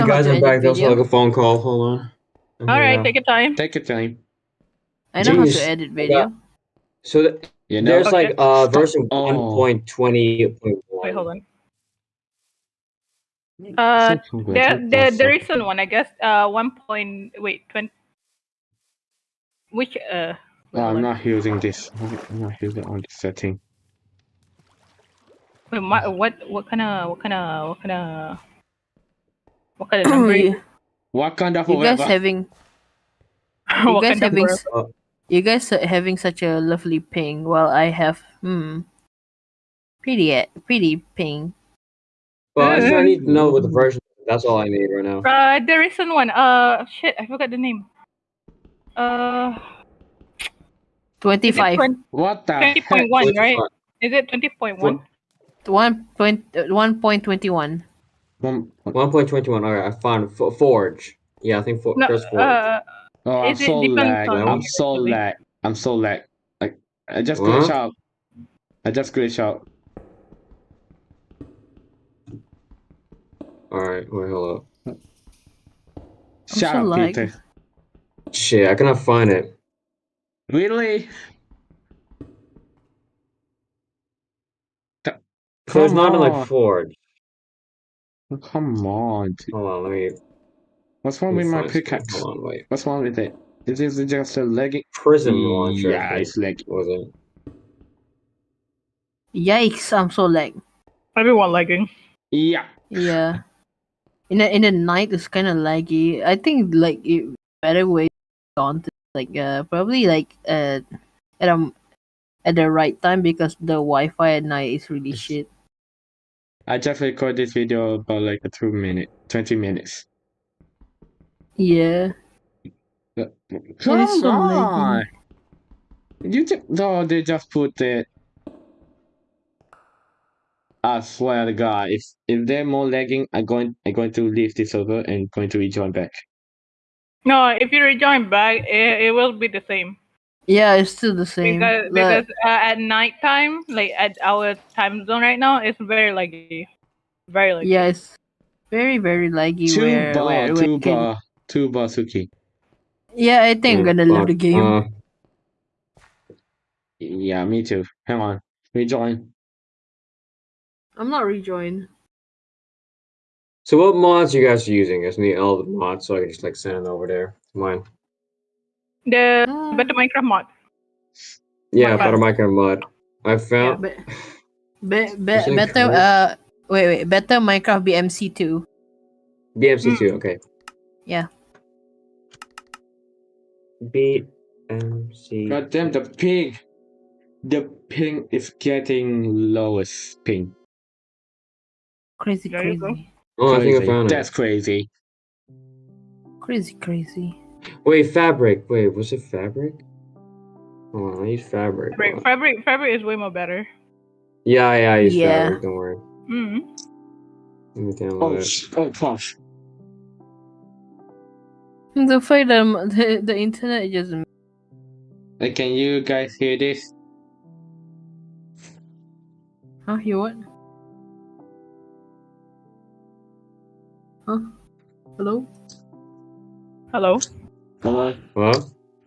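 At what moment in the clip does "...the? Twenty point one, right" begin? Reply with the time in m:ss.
0:52.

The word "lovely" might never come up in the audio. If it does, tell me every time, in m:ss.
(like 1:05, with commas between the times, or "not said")
0:36.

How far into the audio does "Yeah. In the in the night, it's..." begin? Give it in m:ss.
1:42.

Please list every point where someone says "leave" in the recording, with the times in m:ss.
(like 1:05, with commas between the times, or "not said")
2:14, 2:34.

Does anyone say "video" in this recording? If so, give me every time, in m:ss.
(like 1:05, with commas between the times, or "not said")
0:05, 1:57.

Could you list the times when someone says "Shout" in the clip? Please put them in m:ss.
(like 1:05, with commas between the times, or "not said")
1:16.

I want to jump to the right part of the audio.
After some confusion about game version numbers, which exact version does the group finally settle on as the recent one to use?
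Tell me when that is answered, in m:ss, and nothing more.
0:58.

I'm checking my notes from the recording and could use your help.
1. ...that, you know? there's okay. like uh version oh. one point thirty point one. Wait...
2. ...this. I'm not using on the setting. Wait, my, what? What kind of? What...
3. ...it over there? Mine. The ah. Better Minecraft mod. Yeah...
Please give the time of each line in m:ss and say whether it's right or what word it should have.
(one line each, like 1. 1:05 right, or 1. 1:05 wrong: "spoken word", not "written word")
1. 0:07 wrong: "twenty", not "thirty"
2. 0:21 right
3. 2:46 right.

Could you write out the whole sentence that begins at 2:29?
Tuba, where, where, where tuba, can...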